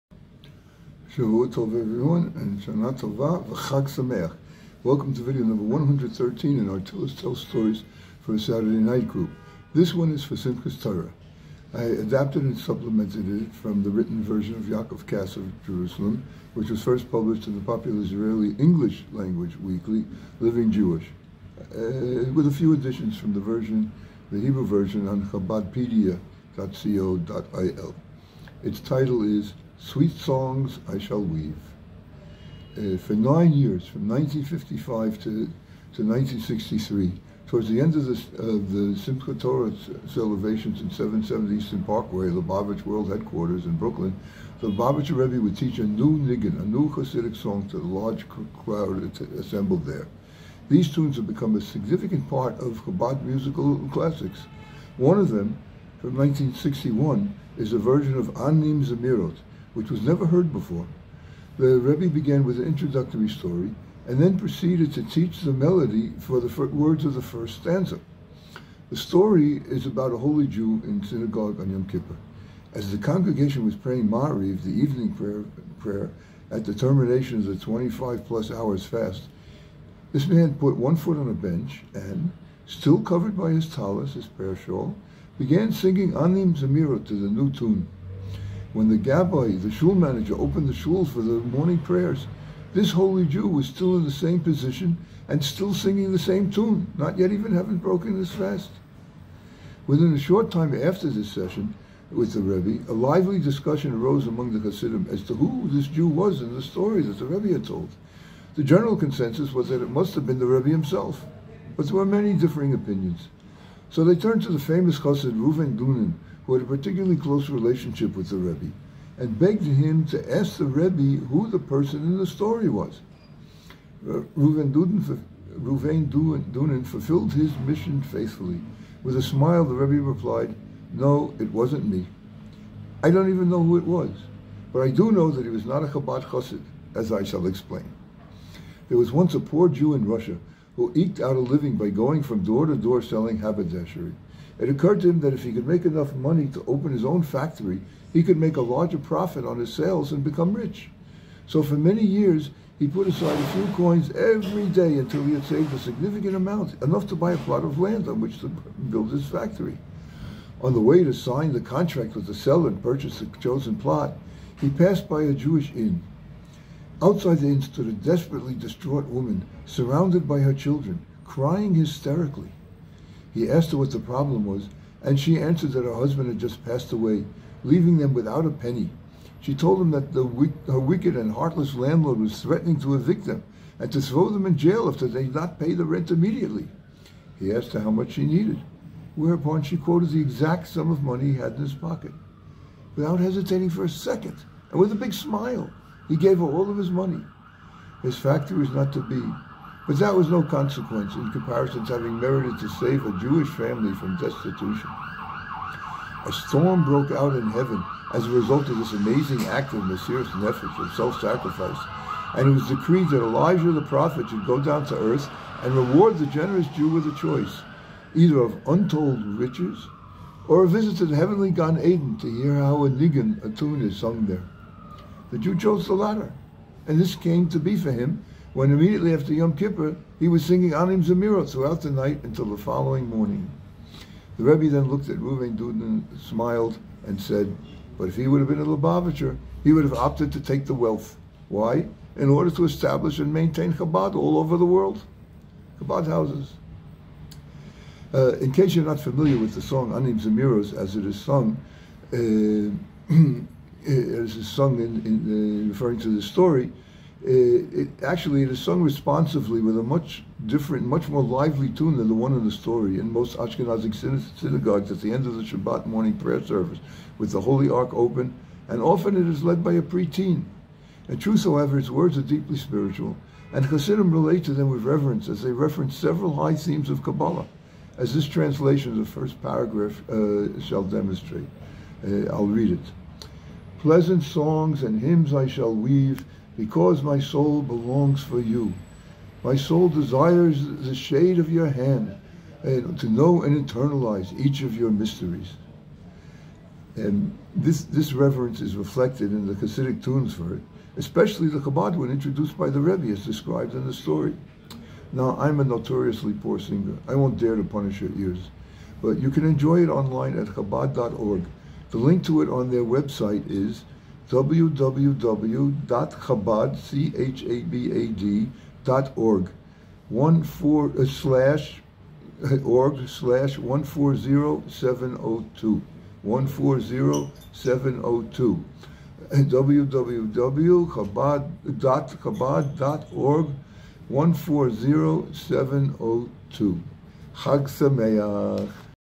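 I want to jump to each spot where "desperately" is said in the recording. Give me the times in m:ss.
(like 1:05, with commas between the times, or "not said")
2:47.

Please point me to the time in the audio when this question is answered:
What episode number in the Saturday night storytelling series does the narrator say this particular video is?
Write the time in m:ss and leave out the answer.
0:05.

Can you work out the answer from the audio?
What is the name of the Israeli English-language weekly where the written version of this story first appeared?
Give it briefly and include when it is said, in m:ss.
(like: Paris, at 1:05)
Living Jewish, at 0:20.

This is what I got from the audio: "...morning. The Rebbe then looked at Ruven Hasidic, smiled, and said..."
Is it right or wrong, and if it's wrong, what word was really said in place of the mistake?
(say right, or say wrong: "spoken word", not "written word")
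wrong: "Duden", not "Hasidic".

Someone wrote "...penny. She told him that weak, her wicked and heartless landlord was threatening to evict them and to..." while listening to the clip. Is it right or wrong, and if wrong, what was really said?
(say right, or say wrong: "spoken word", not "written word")
right.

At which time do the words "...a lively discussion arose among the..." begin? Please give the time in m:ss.
1:42.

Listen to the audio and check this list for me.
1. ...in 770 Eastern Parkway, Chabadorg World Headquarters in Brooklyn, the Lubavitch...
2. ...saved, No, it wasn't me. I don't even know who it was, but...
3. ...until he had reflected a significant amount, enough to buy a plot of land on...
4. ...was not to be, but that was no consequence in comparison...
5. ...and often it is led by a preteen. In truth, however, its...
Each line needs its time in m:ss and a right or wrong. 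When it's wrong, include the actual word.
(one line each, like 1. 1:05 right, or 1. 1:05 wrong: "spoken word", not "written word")
1. 0:40 wrong: "Lubavitch", not "Chabadorg"
2. 2:10 wrong: "replied", not "saved"
3. 2:34 wrong: "saved", not "reflected"
4. 3:18 right
5. 4:28 right.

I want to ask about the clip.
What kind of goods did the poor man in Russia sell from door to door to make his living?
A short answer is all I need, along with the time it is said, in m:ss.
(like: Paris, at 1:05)
Haberdashery, at 2:23.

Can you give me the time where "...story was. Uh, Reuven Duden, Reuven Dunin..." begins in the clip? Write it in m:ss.
2:02.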